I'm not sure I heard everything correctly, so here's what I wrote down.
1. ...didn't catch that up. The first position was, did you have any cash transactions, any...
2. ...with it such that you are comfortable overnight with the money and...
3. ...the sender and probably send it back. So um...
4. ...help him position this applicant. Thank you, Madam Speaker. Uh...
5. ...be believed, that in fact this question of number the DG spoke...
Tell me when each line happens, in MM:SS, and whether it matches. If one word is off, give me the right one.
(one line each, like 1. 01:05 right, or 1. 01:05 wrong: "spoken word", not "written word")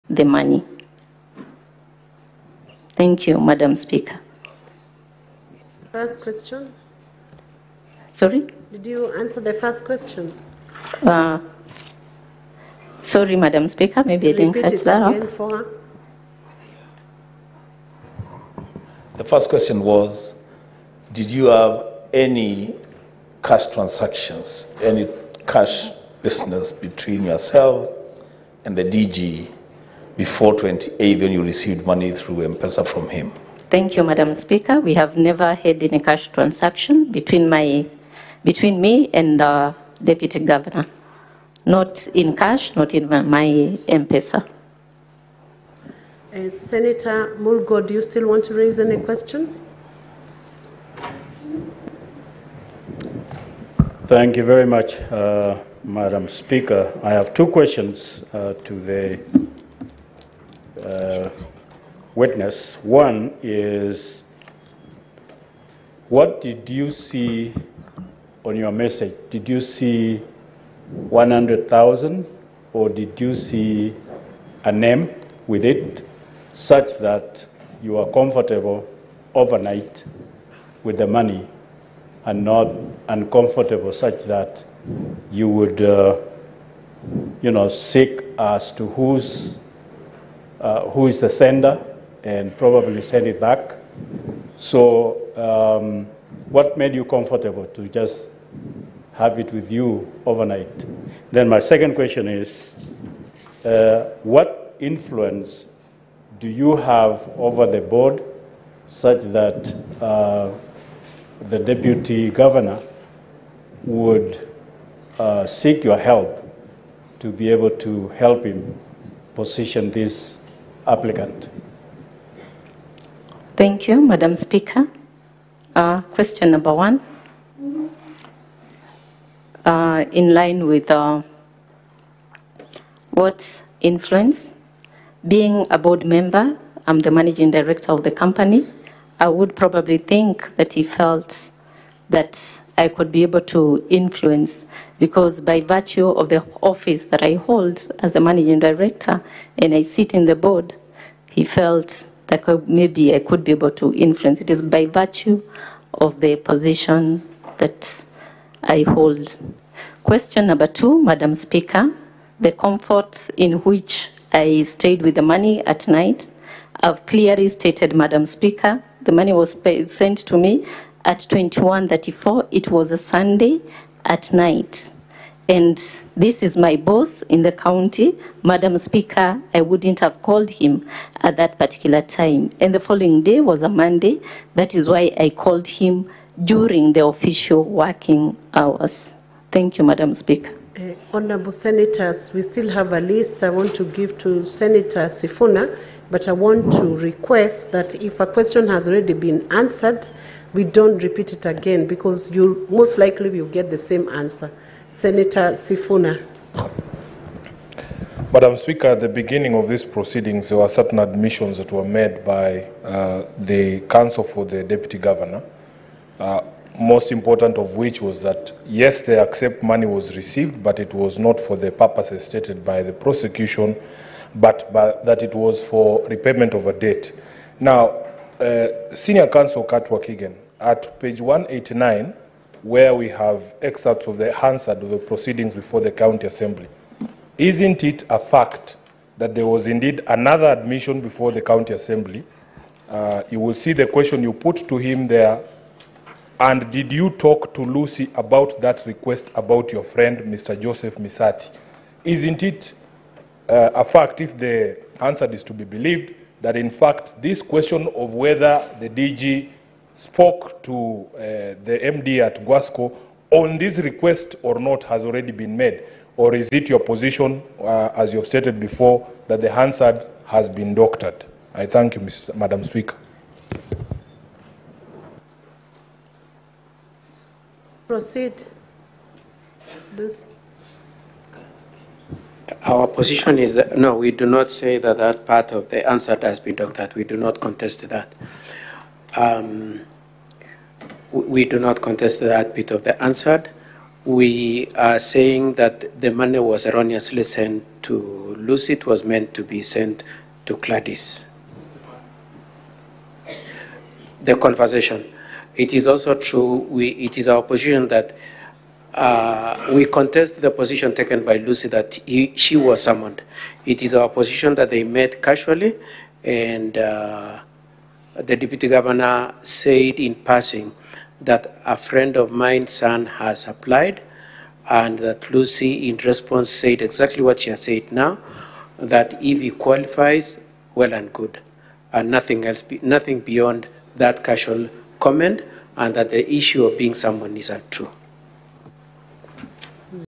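1. 00:14 wrong: "question", not "position"
2. 01:15 right
3. 01:31 right
4. 01:58 right
5. 04:15 wrong: "whether", not "number".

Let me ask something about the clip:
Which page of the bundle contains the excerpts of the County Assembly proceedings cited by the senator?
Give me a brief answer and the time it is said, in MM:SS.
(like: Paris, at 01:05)
189, at 03:51.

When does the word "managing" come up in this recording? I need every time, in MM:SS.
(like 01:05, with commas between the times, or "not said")
02:17, 02:28.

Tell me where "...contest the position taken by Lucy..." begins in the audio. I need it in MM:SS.
05:09.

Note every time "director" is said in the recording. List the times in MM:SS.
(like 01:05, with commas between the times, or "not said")
02:17, 02:28.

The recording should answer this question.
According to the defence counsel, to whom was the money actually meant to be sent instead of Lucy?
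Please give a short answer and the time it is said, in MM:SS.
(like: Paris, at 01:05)
Gladys, at 05:00.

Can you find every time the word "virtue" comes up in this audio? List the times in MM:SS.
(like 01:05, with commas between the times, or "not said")
02:25, 02:34.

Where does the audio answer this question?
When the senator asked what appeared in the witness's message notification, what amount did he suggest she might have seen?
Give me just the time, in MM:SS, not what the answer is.
01:11.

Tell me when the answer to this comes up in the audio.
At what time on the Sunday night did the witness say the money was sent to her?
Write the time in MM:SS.
02:51.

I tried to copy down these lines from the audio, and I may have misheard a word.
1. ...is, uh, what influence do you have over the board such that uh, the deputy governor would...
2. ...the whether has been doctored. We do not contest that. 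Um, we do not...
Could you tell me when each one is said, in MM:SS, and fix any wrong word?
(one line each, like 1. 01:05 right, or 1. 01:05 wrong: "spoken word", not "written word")
1. 01:42 right
2. 04:45 wrong: "answer", not "whether".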